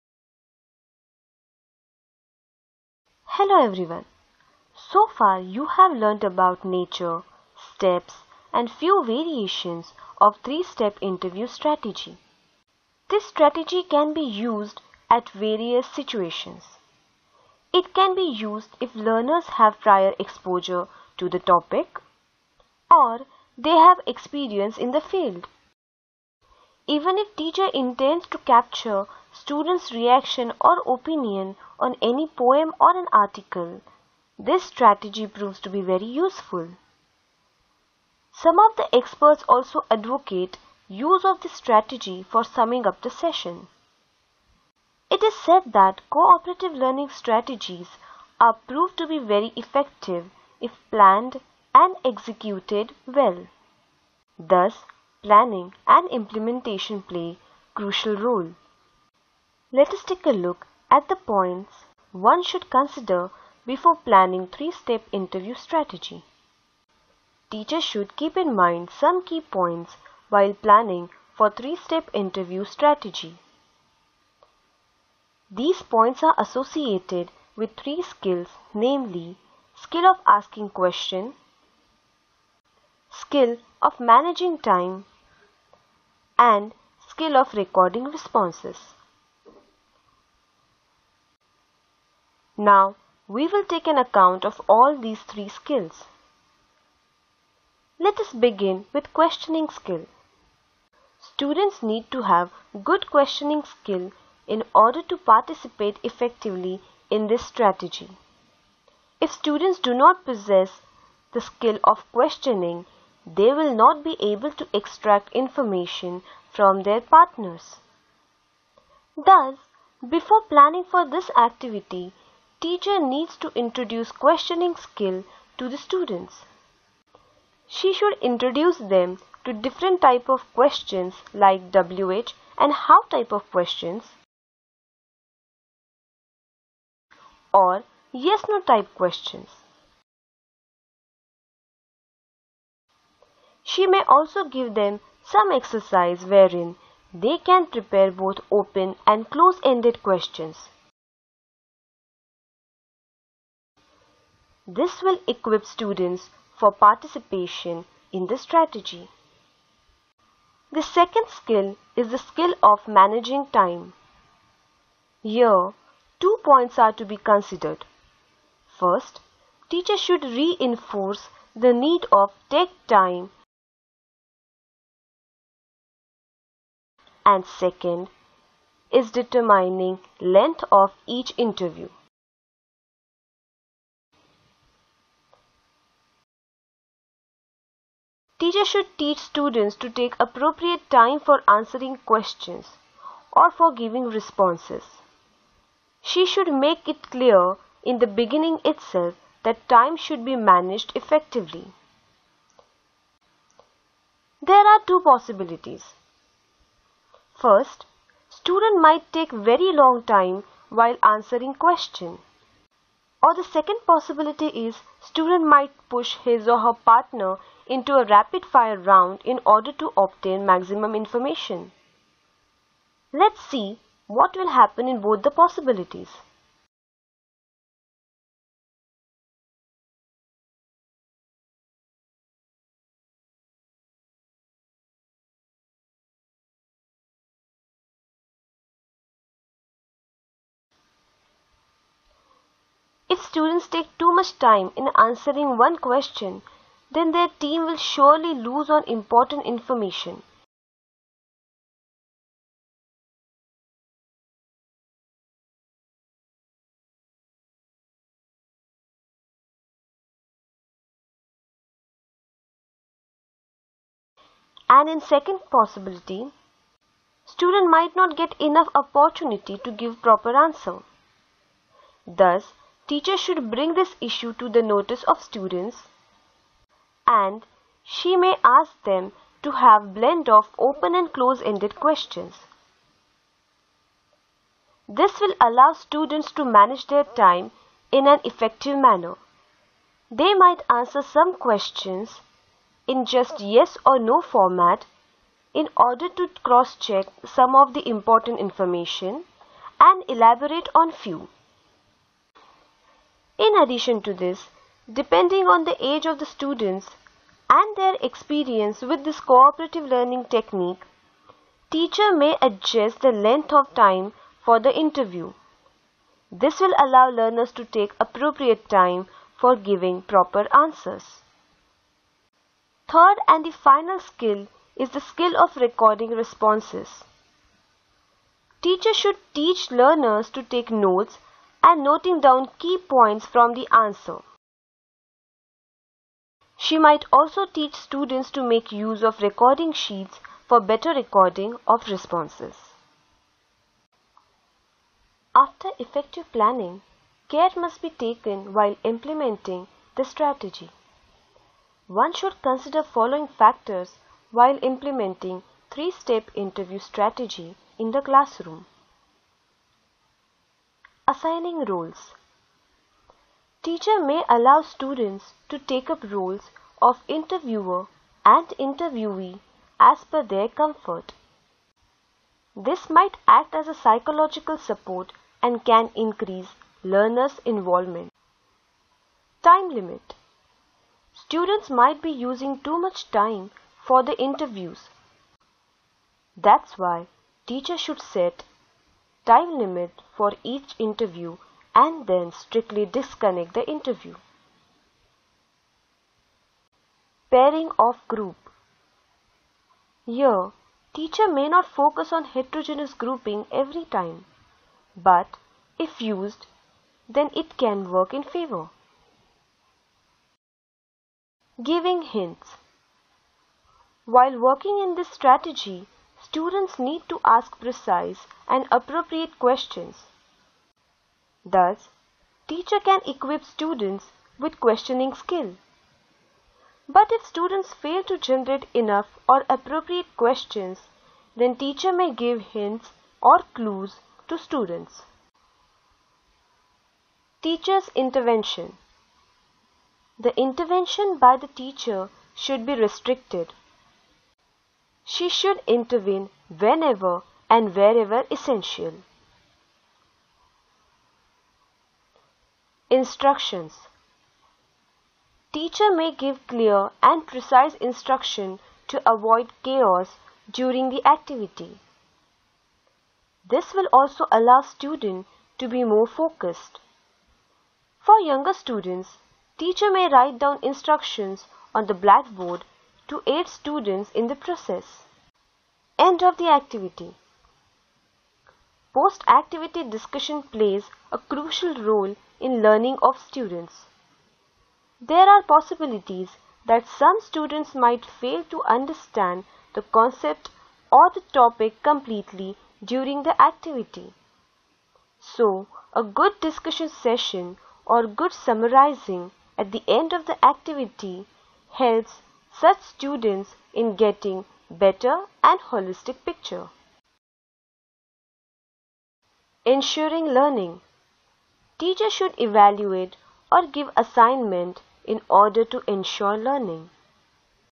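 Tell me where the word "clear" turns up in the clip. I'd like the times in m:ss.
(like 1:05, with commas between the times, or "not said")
3:17, 7:36.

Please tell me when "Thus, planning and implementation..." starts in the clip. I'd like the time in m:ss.
0:54.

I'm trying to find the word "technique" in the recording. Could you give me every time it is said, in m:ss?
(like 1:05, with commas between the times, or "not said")
5:10.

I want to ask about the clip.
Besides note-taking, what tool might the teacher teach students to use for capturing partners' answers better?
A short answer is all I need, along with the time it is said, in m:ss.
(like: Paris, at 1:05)
Recording sheets, at 5:39.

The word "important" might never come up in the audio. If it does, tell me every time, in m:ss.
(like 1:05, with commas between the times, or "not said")
4:08, 4:57.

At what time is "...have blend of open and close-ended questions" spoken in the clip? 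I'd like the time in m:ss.
4:39.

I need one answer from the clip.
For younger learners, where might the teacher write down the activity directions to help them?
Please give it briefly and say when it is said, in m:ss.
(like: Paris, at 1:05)
On the blackboard, at 7:51.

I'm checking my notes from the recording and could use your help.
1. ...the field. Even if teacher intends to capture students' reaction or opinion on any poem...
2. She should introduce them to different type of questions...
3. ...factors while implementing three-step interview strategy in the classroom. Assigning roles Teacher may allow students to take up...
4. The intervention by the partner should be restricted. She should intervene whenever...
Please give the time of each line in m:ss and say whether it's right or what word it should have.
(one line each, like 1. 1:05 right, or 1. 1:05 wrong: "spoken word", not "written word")
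1. 0:24 right
2. 2:07 right
3. 5:53 right
4. 7:20 wrong: "teacher", not "partner".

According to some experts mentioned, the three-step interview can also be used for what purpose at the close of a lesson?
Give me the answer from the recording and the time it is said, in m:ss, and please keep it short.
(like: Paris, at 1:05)
Summing up the session, at 0:42.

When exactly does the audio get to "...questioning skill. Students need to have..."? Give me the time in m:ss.
1:39.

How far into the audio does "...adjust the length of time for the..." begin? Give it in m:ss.
5:12.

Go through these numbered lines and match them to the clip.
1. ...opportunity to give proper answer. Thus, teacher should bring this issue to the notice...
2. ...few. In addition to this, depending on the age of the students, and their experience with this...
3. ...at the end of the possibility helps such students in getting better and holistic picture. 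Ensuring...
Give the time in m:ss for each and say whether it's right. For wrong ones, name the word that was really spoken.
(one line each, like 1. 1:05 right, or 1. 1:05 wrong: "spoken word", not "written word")
1. 4:28 right
2. 5:00 right
3. 8:19 wrong: "activity", not "possibility".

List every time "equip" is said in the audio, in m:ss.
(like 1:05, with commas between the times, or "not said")
2:35, 7:03.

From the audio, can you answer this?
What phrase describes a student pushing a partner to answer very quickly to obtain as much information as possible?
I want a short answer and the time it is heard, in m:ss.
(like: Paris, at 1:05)
Rapid fire round, at 3:38.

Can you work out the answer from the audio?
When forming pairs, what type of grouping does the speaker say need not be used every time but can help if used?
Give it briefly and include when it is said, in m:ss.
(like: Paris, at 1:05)
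Heterogeneous grouping, at 6:42.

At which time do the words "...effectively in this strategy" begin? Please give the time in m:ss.
1:46.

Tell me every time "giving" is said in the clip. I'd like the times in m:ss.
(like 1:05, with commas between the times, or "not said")
3:13, 5:19, 6:51.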